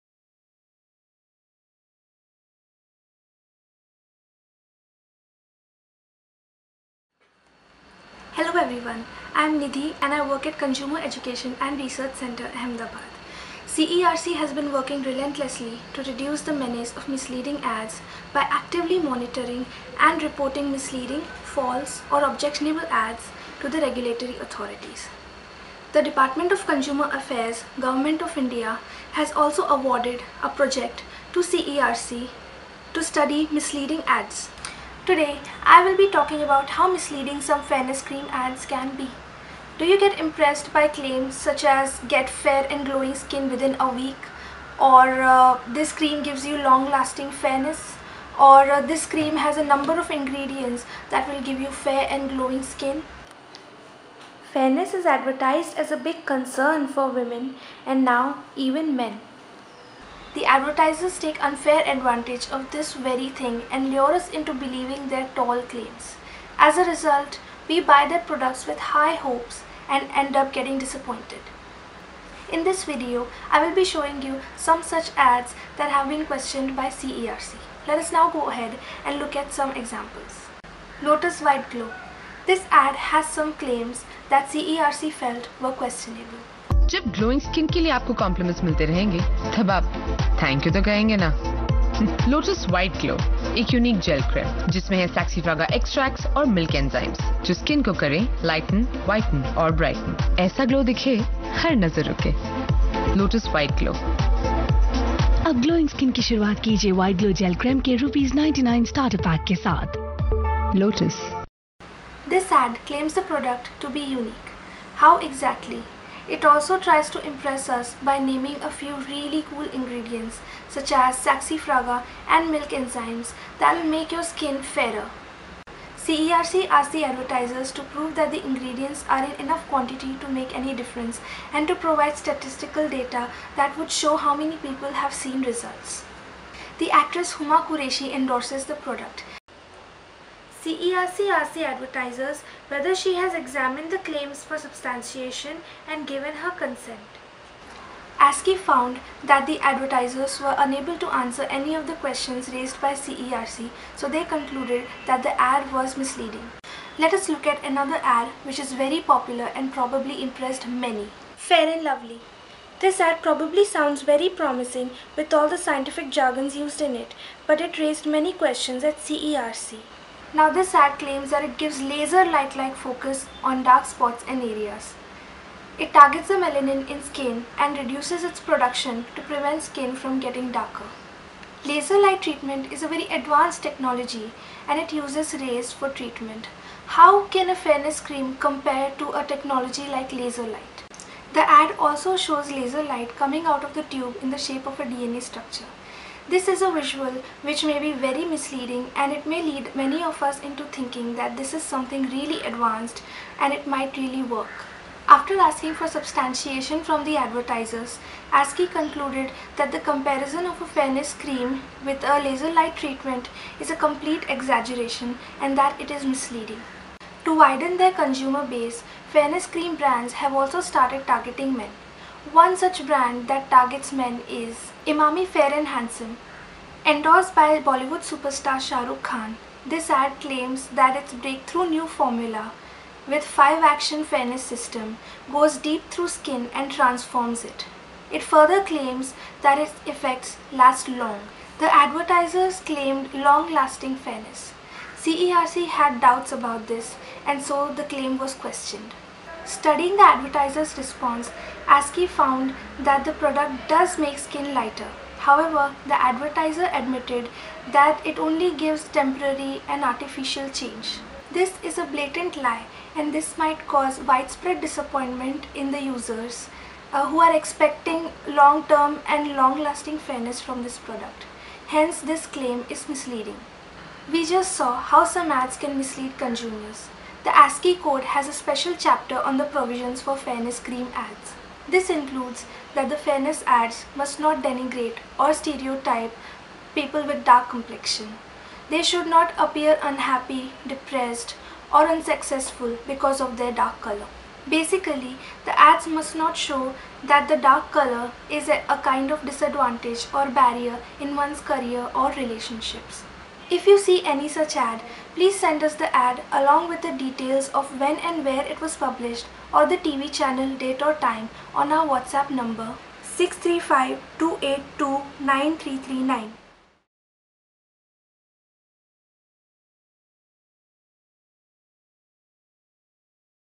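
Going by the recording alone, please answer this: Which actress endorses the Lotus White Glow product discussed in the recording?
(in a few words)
Huma Qureshi.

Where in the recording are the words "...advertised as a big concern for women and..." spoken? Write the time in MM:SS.
00:55.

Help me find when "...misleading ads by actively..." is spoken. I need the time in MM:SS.
00:17.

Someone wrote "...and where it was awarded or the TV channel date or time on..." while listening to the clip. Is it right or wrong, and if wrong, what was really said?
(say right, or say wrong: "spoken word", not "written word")
wrong: "published", not "awarded".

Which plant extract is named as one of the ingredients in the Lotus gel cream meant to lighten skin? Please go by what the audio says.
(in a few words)
Saxifraga.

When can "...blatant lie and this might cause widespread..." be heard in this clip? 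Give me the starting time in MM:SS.
04:21.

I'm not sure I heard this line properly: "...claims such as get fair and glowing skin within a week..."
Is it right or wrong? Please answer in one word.
right.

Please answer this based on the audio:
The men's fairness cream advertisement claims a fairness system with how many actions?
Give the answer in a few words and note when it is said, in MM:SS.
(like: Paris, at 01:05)
5, at 03:53.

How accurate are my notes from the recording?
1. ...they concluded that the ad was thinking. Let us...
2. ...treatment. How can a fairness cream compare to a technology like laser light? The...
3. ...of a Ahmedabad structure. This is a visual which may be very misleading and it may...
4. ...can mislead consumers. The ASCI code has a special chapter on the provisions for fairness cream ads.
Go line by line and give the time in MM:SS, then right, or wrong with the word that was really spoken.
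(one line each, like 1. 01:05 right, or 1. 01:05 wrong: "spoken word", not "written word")
1. 02:34 wrong: "misleading", not "thinking"
2. 03:05 right
3. 03:14 wrong: "DNA", not "Ahmedabad"
4. 04:35 right.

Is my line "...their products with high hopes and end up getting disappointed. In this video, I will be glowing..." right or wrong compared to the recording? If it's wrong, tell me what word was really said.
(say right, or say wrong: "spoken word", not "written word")
wrong: "showing", not "glowing".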